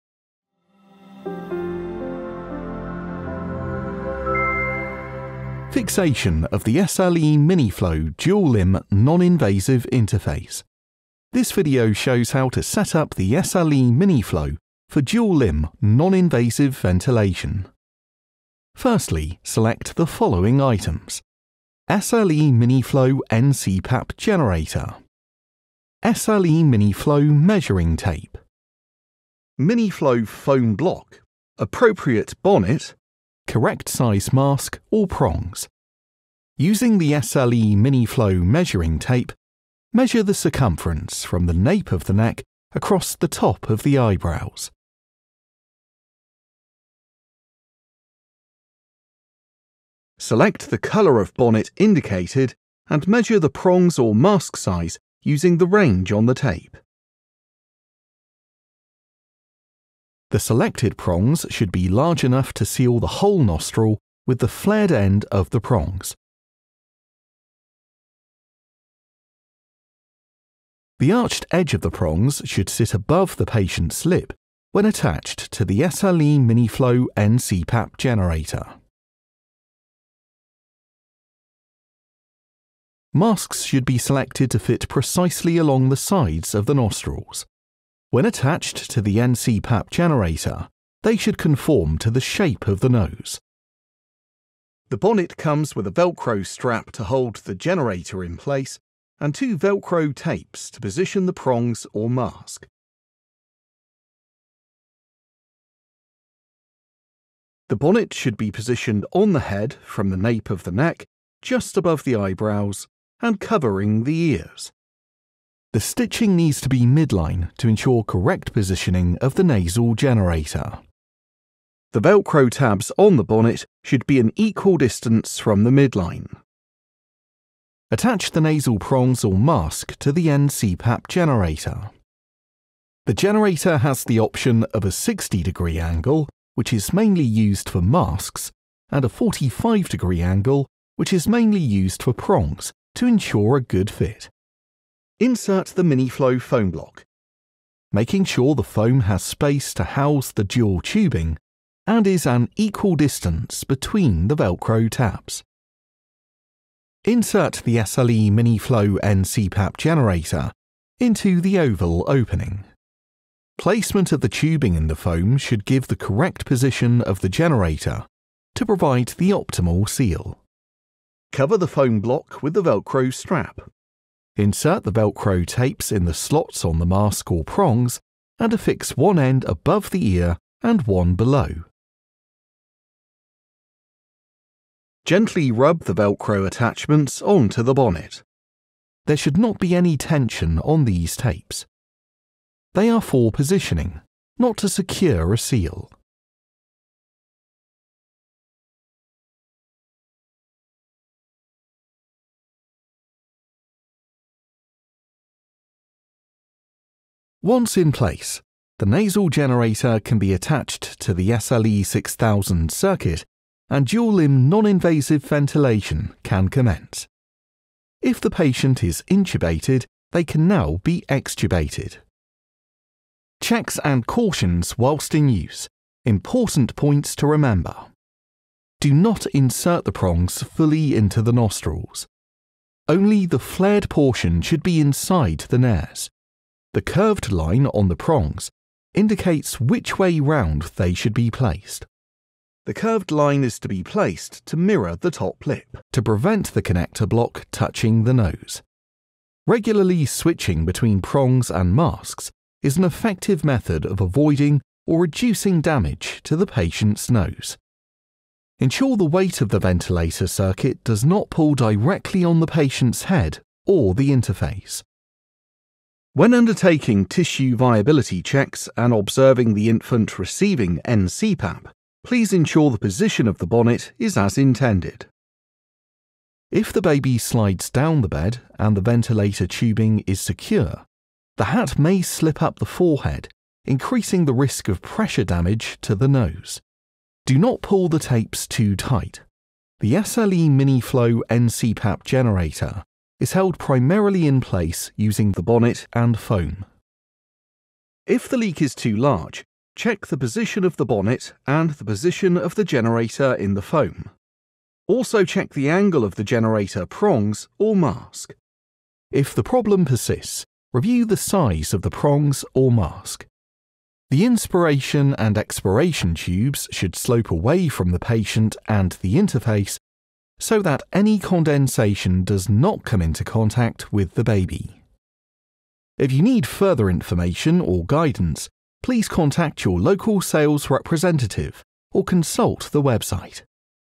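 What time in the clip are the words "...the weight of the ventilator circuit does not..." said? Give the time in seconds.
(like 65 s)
258 s.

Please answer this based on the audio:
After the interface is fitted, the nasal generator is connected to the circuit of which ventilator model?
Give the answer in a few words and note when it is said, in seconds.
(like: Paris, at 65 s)
SLE6000, at 211 s.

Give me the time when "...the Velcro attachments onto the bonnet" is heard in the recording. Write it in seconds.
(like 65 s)
185 s.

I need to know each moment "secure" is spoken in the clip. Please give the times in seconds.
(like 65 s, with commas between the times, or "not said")
194 s, 280 s.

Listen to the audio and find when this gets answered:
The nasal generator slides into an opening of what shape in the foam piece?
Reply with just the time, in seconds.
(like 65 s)
161 s.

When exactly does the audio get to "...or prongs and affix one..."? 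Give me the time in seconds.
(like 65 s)
177 s.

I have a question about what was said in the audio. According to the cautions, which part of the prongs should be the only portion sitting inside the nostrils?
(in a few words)
the flared portion.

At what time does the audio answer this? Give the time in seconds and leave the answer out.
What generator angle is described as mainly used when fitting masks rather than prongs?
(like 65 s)
134 s.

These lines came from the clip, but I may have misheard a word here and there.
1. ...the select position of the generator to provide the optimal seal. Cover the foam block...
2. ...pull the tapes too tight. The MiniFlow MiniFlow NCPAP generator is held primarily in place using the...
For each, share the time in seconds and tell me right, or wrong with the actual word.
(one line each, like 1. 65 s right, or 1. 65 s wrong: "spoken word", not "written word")
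1. 165 s wrong: "correct", not "select"
2. 287 s wrong: "SLE", not "MiniFlow".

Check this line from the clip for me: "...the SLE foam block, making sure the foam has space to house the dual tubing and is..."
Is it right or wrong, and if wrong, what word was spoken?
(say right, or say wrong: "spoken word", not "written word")
wrong: "MiniFlow", not "SLE".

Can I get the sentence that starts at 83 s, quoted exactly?
Masks should be selected to fit precisely along the sides of the nostrils.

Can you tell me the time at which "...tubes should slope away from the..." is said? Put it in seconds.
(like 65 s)
316 s.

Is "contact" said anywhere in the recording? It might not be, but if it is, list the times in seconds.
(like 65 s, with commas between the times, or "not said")
323 s, 329 s.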